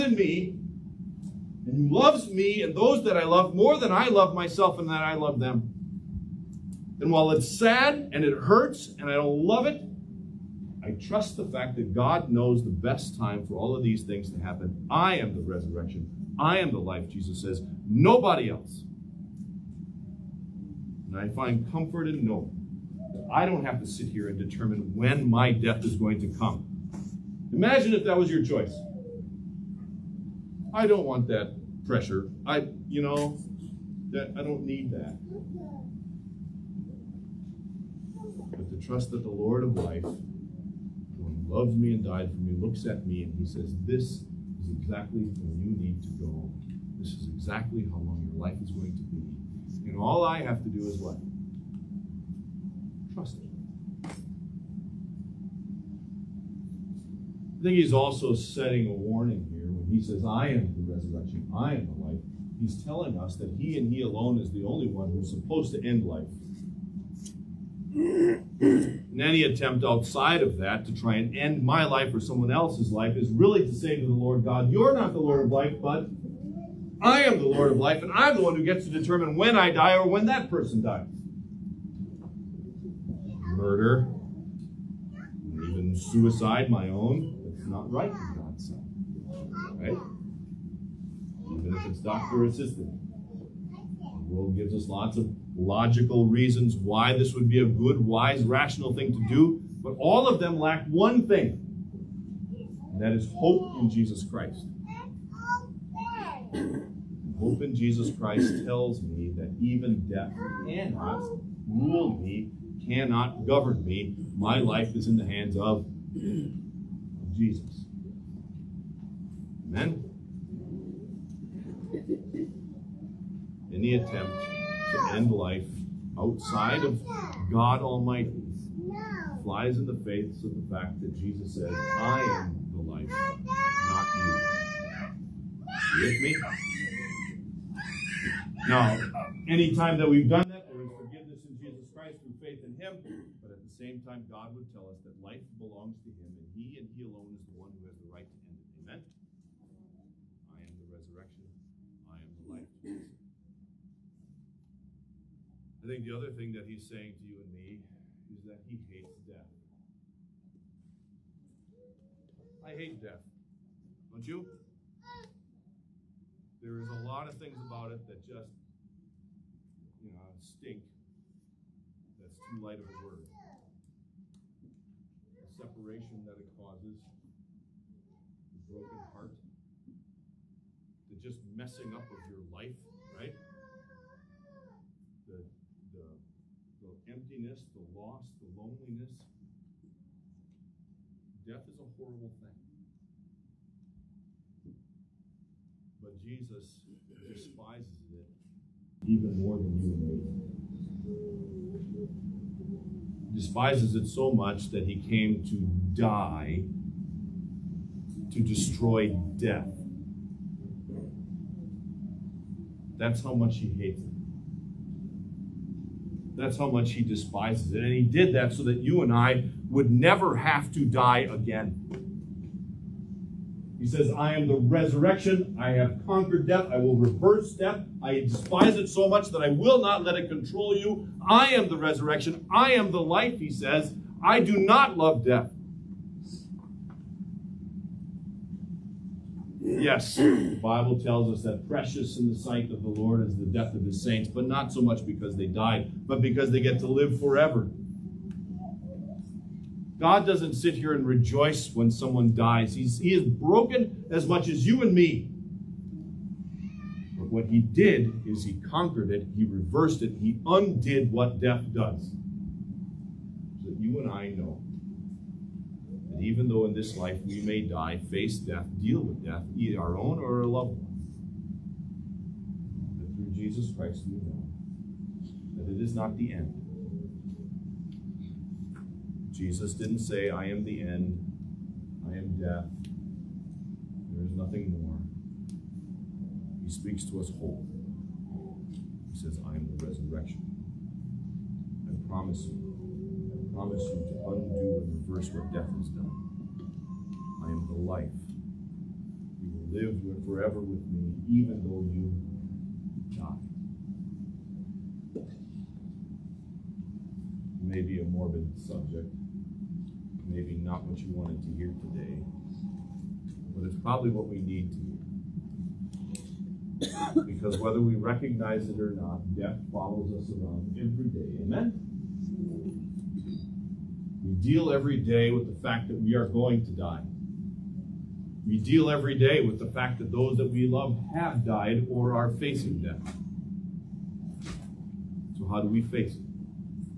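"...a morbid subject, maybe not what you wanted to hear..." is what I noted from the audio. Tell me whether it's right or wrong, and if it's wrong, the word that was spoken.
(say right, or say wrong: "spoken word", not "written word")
right.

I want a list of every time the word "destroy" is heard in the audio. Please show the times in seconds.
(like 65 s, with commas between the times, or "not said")
208 s.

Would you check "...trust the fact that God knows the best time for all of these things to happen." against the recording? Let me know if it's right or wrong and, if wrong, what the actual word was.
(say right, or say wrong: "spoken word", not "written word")
right.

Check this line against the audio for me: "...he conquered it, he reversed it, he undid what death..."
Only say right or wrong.
right.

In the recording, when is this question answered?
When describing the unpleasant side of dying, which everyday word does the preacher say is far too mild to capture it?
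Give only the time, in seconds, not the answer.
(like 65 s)
170 s.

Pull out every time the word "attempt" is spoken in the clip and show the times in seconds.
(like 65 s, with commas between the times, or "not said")
69 s, 123 s.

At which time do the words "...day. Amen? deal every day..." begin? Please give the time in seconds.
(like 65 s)
321 s.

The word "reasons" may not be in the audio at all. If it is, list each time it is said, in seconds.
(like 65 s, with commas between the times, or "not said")
96 s.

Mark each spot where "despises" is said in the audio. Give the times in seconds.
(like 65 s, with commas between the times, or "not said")
197 s, 203 s, 217 s, 228 s.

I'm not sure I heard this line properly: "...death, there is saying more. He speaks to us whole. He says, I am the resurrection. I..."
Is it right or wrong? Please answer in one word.
wrong.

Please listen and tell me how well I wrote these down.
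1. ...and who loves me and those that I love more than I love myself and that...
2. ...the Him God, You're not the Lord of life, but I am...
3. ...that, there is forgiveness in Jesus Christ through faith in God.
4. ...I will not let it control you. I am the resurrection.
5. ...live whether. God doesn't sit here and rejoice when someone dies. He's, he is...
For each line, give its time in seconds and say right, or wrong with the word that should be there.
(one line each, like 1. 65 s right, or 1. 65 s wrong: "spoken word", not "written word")
1. 1 s right
2. 74 s wrong: "Lord", not "Him"
3. 140 s wrong: "Him", not "God"
4. 229 s right
5. 246 s wrong: "forever", not "whether".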